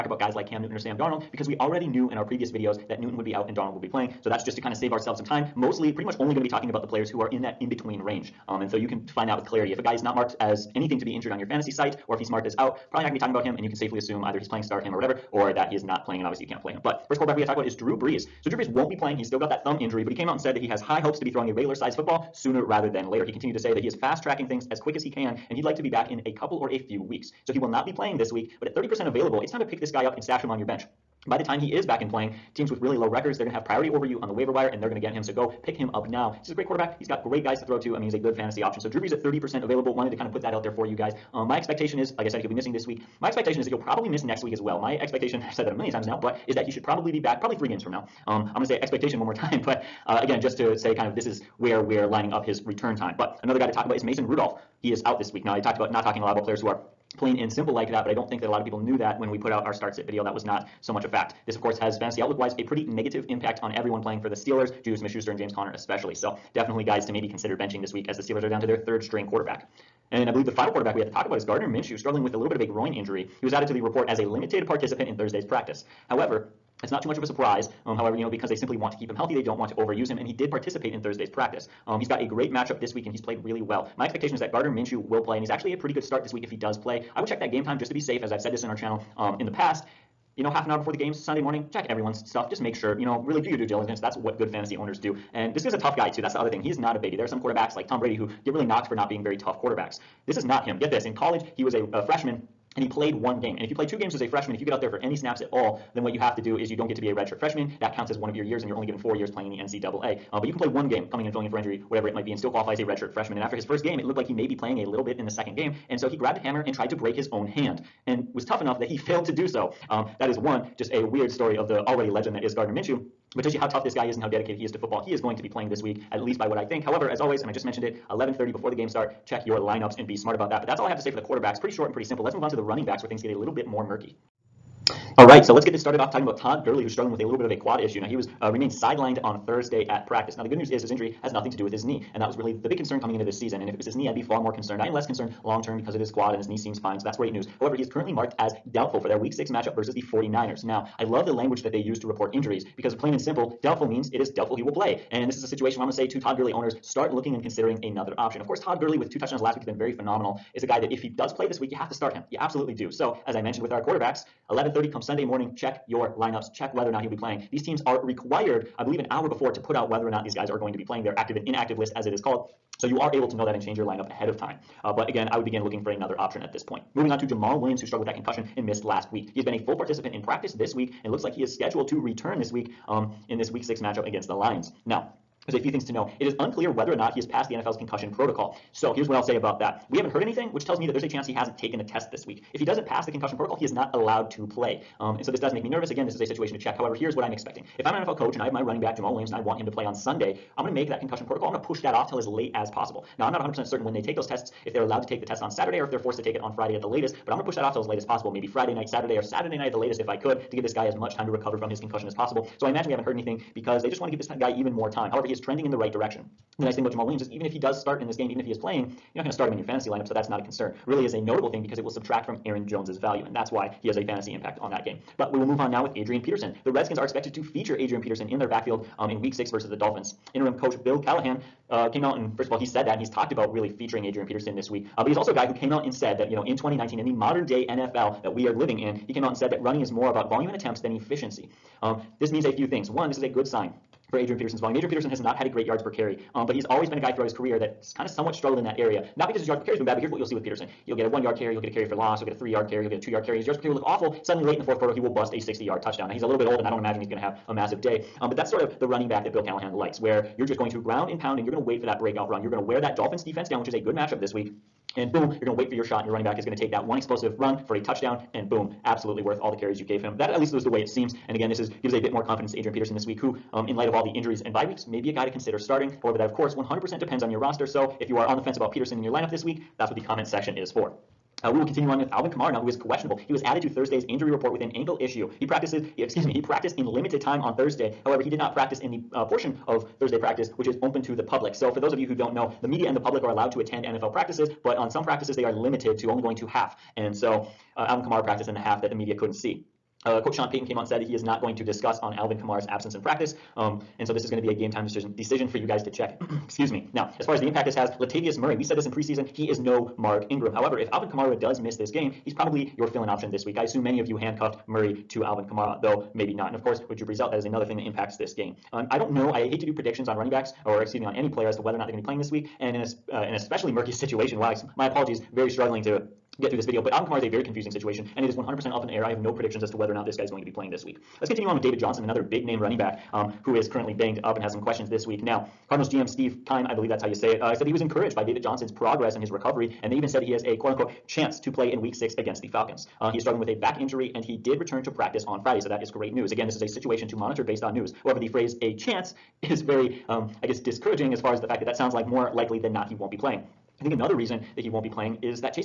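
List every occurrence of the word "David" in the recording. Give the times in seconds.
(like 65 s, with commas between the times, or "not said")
331 s, 338 s.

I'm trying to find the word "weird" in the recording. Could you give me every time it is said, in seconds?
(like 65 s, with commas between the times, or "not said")
121 s.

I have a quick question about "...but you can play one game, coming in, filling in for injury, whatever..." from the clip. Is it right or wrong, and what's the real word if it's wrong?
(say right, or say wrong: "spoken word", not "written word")
right.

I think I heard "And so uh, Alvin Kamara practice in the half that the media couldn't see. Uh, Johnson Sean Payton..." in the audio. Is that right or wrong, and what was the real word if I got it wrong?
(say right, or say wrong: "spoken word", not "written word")
wrong: "Coach", not "Johnson".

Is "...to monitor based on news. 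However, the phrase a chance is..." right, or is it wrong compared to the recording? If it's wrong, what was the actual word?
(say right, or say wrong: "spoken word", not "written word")
right.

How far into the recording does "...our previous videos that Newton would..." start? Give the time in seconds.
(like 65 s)
2 s.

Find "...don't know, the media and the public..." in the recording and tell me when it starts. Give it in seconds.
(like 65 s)
292 s.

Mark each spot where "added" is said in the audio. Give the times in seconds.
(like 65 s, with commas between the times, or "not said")
73 s, 283 s.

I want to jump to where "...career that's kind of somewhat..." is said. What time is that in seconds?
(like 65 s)
247 s.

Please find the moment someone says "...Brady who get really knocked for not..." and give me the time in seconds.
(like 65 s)
97 s.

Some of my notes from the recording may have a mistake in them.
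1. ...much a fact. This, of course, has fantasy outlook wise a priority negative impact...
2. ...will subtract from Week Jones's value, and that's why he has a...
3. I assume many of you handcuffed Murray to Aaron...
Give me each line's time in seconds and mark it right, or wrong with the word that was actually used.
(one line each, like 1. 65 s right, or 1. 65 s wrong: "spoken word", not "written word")
1. 60 s wrong: "pretty", not "priority"
2. 221 s wrong: "Aaron", not "Week"
3. 313 s wrong: "Alvin", not "Aaron".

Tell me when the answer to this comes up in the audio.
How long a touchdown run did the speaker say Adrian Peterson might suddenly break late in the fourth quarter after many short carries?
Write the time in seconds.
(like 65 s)
255 s.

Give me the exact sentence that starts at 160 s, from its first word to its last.
Is a guy that if he does play this week, you have to start him.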